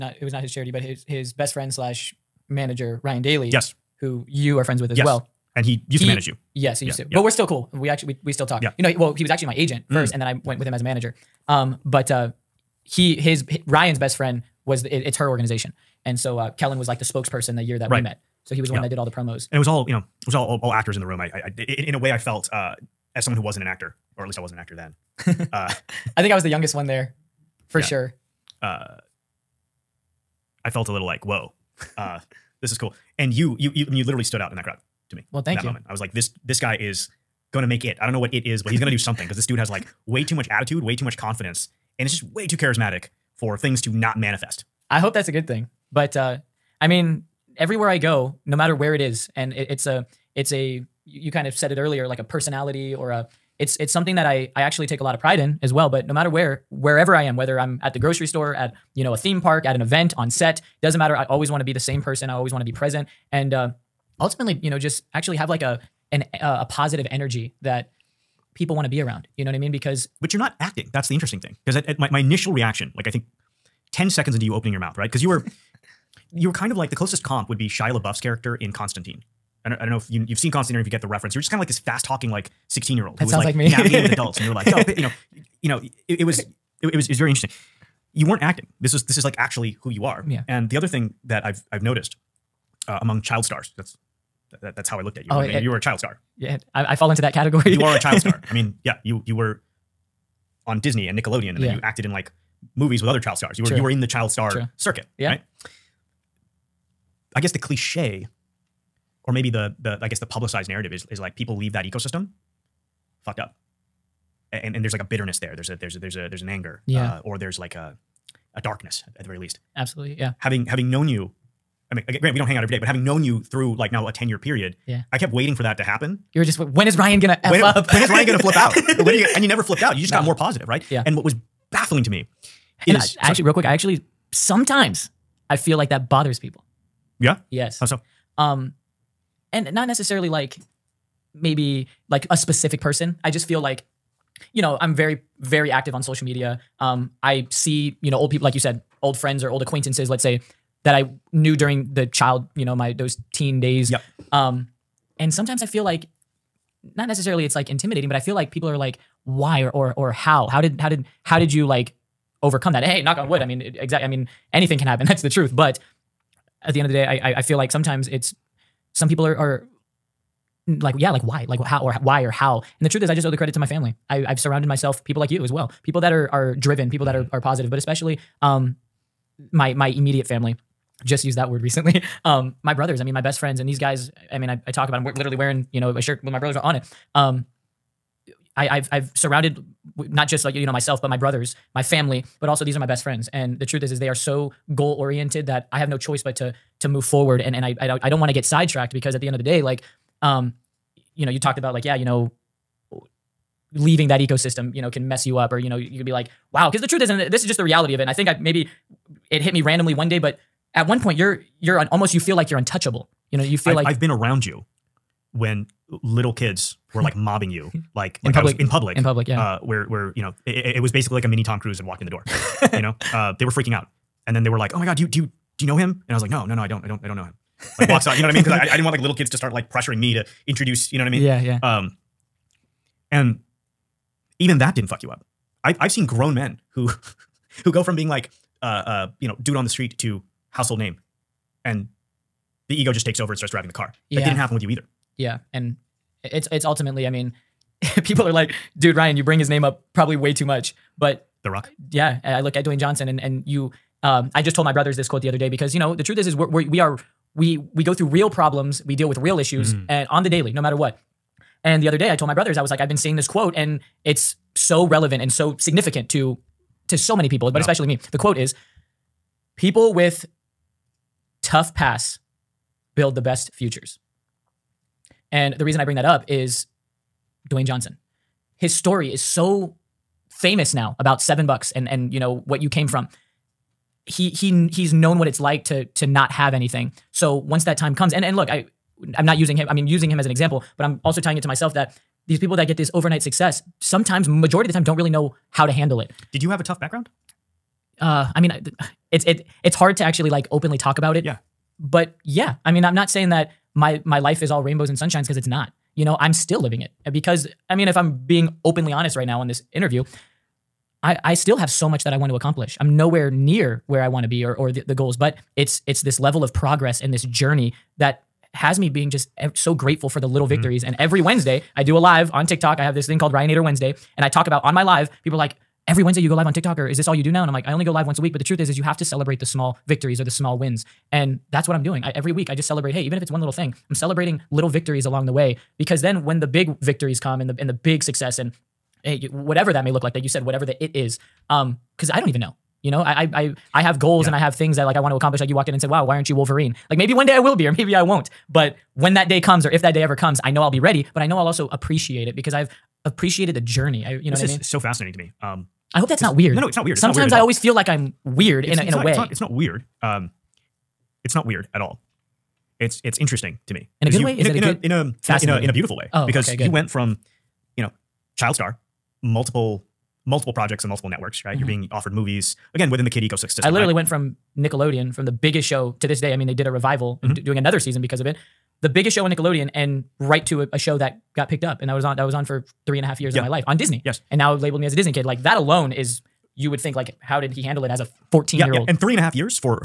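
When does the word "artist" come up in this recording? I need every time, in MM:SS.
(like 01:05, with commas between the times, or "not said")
not said.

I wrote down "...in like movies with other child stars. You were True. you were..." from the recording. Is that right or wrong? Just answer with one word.
right.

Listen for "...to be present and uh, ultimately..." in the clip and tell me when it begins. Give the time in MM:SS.
01:02.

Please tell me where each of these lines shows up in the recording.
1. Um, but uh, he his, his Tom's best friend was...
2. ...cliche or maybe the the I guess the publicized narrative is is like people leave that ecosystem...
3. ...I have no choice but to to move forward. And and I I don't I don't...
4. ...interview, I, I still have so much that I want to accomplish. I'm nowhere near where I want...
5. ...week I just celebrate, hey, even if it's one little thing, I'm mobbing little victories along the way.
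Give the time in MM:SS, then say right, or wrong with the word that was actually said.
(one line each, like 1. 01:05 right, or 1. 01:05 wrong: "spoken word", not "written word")
1. 00:11 wrong: "Ryan", not "Tom"
2. 01:47 right
3. 03:15 right
4. 05:09 right
5. 05:32 wrong: "celebrating", not "mobbing".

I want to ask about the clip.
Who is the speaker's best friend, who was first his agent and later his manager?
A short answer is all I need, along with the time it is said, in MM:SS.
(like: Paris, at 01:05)
Ryan Daly, at 00:03.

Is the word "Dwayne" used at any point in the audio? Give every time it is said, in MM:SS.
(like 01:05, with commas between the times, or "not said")
04:12, 04:37.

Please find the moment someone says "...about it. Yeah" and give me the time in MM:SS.
05:00.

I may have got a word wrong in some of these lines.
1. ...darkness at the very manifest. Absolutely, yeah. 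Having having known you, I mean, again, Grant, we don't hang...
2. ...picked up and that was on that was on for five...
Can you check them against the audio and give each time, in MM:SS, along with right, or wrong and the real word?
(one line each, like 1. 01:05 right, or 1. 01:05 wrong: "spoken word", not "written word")
1. 01:58 wrong: "least", not "manifest"
2. 06:21 wrong: "three", not "five".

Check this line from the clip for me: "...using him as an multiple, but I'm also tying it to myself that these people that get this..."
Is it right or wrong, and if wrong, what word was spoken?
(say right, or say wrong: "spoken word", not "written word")
wrong: "example", not "multiple".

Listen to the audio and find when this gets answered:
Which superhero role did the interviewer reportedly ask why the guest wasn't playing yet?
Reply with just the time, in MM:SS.
05:46.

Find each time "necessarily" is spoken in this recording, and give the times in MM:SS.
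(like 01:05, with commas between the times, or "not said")
02:19, 02:37.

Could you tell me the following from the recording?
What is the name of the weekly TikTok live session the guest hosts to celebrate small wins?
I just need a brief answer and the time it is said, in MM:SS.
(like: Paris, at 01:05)
Ryanator Wednesday, at 05:23.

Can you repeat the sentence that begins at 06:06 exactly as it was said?
Oh, because okay, you went from, you know, child star, multiple multiple projects and multiple networks.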